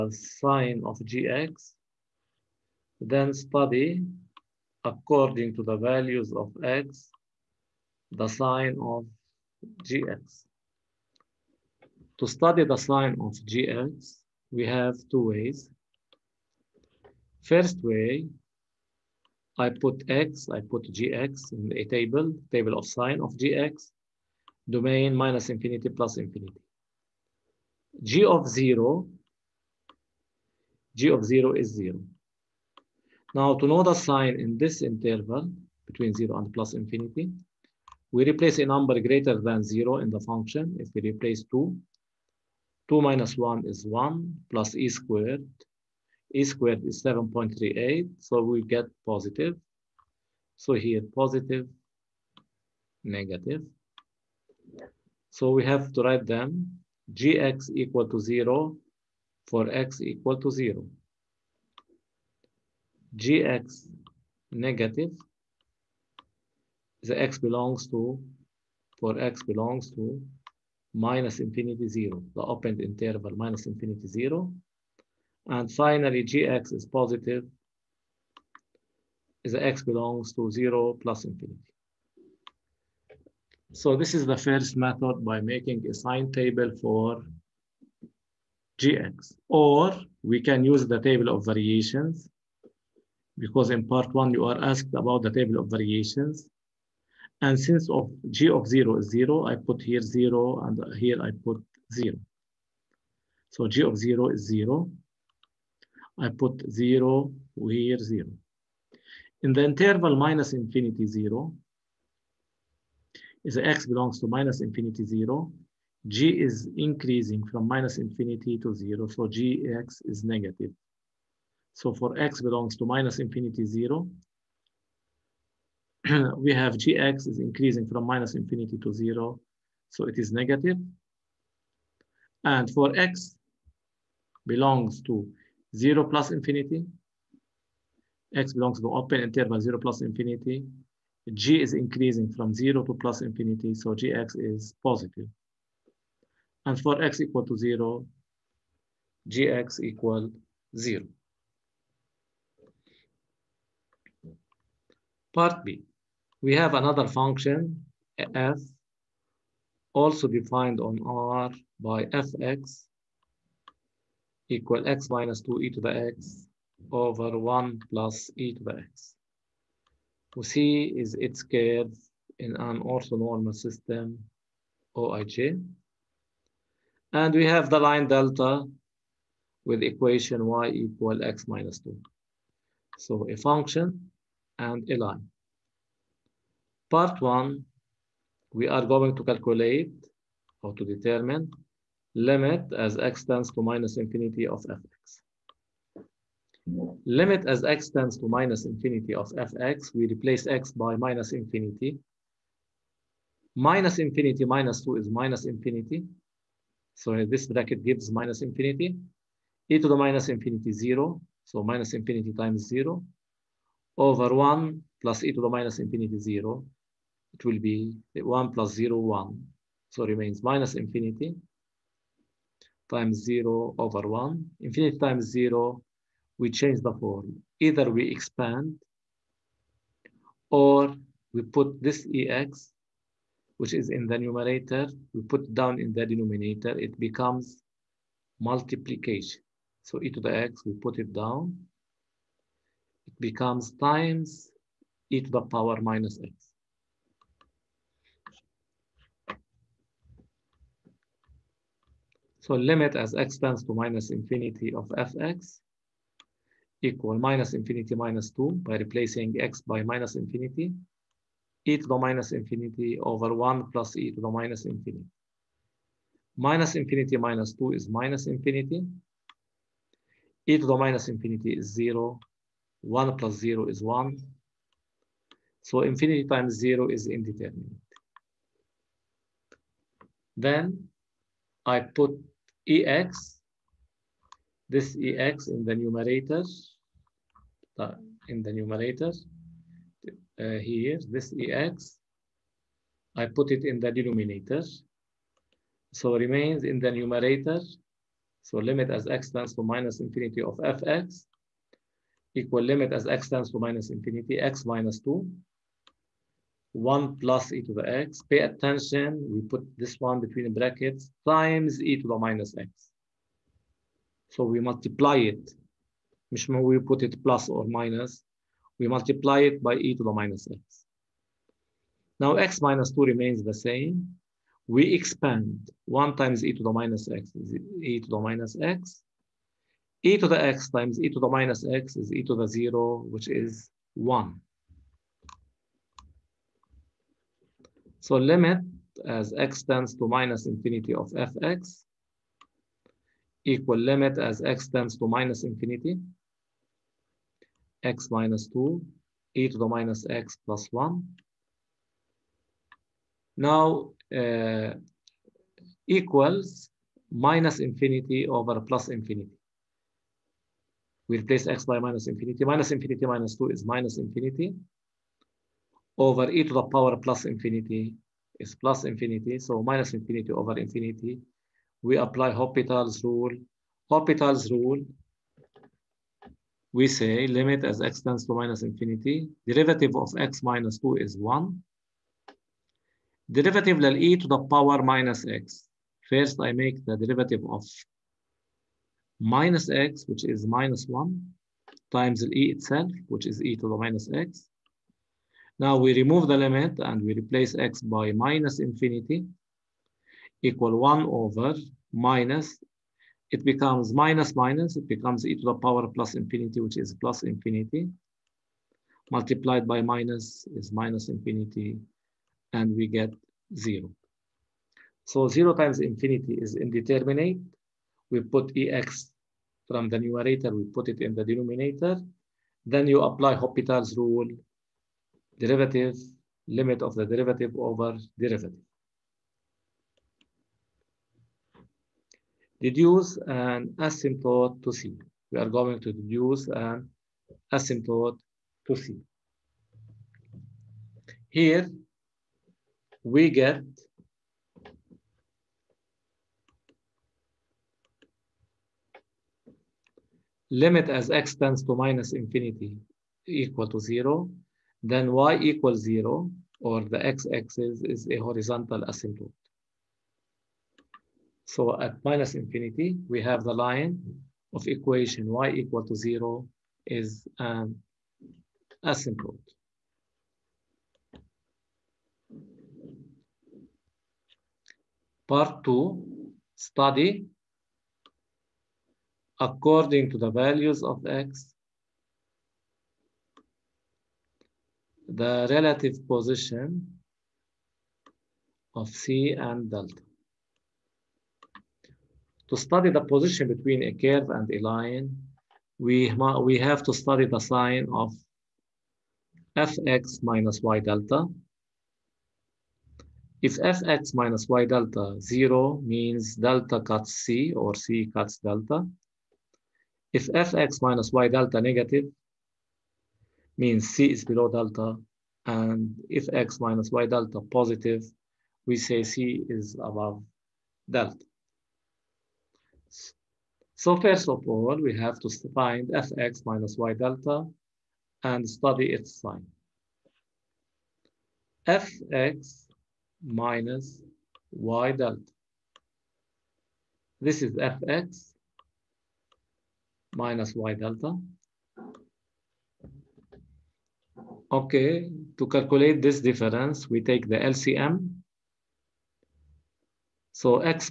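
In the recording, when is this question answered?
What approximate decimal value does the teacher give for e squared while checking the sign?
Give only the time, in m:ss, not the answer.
0:46.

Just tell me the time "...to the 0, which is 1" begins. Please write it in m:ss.
5:32.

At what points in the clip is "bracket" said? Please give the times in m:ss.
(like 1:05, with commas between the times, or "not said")
3:27, 5:10.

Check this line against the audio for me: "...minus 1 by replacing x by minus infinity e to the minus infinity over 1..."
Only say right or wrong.
wrong.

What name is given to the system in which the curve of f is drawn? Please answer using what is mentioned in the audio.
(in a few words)
orthonormal system.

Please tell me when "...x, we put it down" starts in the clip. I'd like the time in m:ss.
4:00.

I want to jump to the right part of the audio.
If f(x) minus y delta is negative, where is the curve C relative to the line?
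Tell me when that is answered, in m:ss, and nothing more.
8:33.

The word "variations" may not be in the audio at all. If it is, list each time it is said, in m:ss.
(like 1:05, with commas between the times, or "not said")
1:31, 1:35.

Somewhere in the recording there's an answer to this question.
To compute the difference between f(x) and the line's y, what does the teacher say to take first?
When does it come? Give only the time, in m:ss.
9:06.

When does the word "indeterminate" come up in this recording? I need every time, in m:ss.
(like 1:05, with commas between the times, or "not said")
4:37, 6:56.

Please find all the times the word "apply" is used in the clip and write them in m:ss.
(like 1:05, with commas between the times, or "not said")
6:11, 7:03.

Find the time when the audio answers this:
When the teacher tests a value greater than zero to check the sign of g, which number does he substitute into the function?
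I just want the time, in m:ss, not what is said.
0:40.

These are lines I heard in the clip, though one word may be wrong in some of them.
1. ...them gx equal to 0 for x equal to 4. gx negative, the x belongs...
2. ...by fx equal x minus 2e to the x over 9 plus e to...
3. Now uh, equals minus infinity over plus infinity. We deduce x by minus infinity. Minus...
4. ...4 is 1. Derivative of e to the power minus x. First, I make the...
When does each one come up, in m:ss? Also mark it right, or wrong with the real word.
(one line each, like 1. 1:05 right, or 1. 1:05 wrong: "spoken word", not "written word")
1. 0:56 wrong: "0", not "4"
2. 2:41 wrong: "1", not "9"
3. 5:53 wrong: "replace", not "deduce"
4. 6:20 wrong: "2", not "4".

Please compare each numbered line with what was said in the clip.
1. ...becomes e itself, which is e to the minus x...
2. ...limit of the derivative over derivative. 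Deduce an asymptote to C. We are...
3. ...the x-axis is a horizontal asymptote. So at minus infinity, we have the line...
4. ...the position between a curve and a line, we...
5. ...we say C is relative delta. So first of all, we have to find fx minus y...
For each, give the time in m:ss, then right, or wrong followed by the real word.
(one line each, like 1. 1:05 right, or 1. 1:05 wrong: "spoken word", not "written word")
1. 6:31 wrong: "times", not "becomes"
2. 7:06 right
3. 7:36 right
4. 8:12 right
5. 8:38 wrong: "above", not "relative".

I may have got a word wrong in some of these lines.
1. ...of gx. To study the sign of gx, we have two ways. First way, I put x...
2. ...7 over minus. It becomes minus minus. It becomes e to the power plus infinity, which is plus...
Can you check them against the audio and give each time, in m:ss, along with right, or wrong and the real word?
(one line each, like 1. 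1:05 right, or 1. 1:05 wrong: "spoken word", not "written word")
1. 0:08 right
2. 6:40 wrong: "1", not "7".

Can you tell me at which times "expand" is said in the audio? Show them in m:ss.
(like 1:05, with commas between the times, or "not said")
3:48, 5:24.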